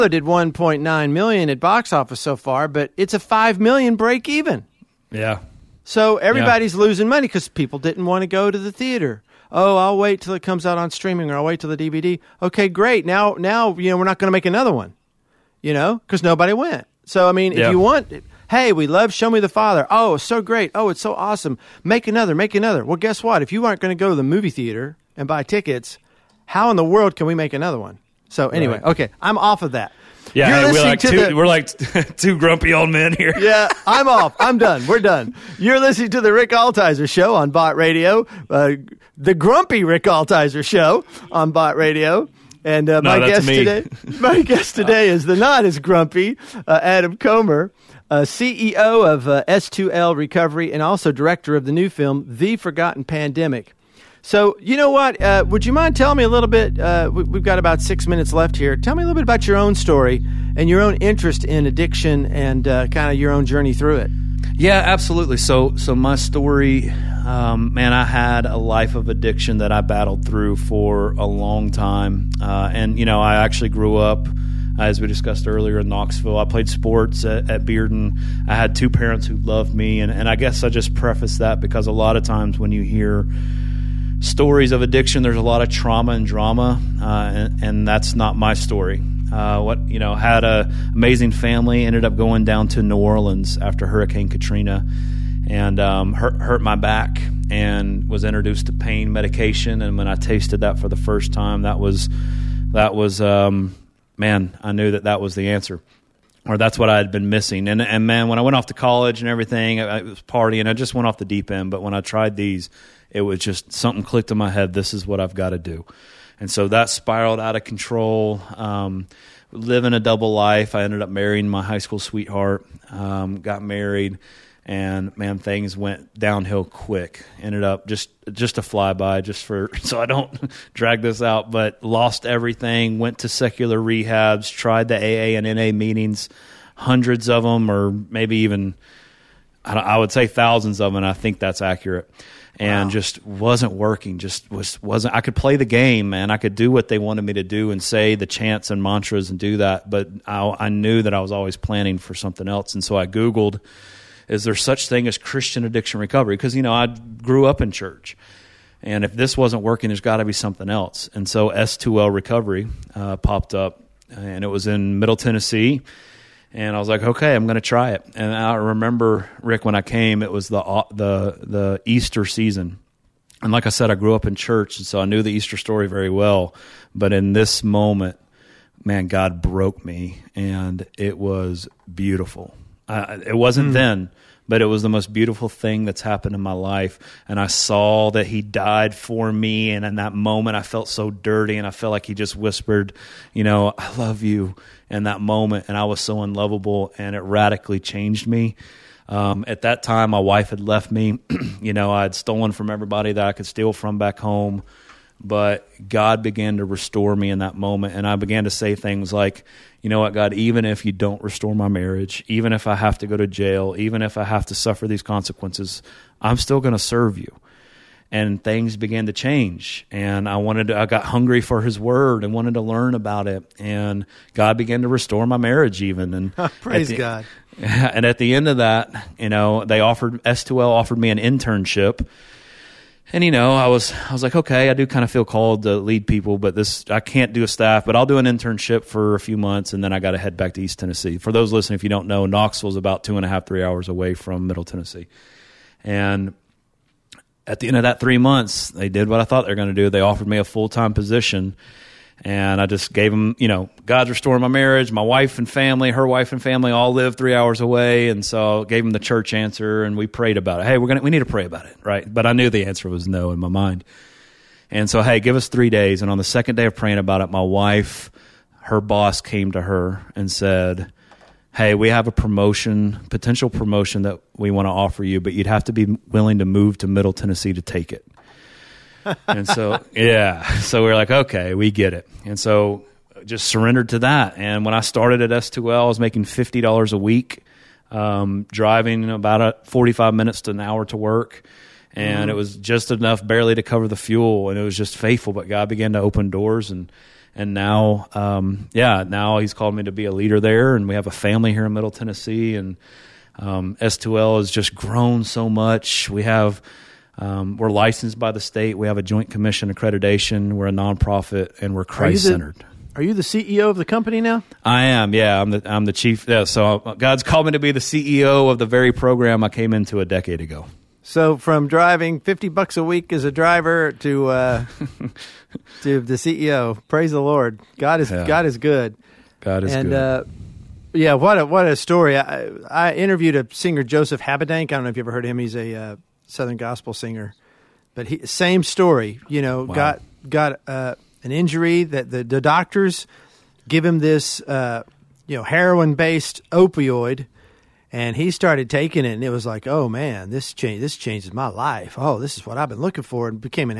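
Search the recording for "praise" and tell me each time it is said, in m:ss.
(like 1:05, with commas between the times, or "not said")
3:46, 5:26.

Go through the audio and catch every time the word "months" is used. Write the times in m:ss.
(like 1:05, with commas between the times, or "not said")
3:59, 4:08.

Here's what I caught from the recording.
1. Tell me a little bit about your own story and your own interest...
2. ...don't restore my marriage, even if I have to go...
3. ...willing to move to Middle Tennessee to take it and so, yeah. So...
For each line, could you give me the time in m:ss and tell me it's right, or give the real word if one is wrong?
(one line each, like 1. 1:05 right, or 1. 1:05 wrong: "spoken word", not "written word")
1. 0:58 right
2. 3:30 right
3. 4:36 right.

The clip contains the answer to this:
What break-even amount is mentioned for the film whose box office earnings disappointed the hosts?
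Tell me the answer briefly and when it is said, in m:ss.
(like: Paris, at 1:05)
5 million, at 0:03.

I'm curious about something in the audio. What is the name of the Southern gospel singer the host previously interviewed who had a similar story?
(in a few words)
Joseph Habedank.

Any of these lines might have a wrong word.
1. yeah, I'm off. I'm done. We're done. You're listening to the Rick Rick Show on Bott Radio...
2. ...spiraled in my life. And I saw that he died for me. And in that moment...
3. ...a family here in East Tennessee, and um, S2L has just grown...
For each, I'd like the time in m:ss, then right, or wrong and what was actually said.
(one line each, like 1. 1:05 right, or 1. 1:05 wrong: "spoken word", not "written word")
1. 0:33 wrong: "Altizer", not "Rick"
2. 3:06 wrong: "happened", not "spiraled"
3. 5:01 wrong: "Middle", not "East".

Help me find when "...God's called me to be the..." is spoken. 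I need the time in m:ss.
5:16.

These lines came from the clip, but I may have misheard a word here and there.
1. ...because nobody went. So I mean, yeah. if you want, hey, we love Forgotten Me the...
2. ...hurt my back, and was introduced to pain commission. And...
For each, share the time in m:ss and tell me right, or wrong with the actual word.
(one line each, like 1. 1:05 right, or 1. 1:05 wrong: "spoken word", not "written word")
1. 0:16 wrong: "Show", not "Forgotten"
2. 1:36 wrong: "medication", not "commission".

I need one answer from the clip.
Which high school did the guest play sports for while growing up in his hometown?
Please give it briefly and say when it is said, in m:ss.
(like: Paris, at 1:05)
Bearden, at 1:17.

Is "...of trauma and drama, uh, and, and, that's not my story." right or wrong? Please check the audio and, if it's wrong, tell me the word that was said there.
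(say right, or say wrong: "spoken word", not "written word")
right.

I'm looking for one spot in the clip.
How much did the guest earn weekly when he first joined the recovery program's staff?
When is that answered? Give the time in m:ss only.
4:46.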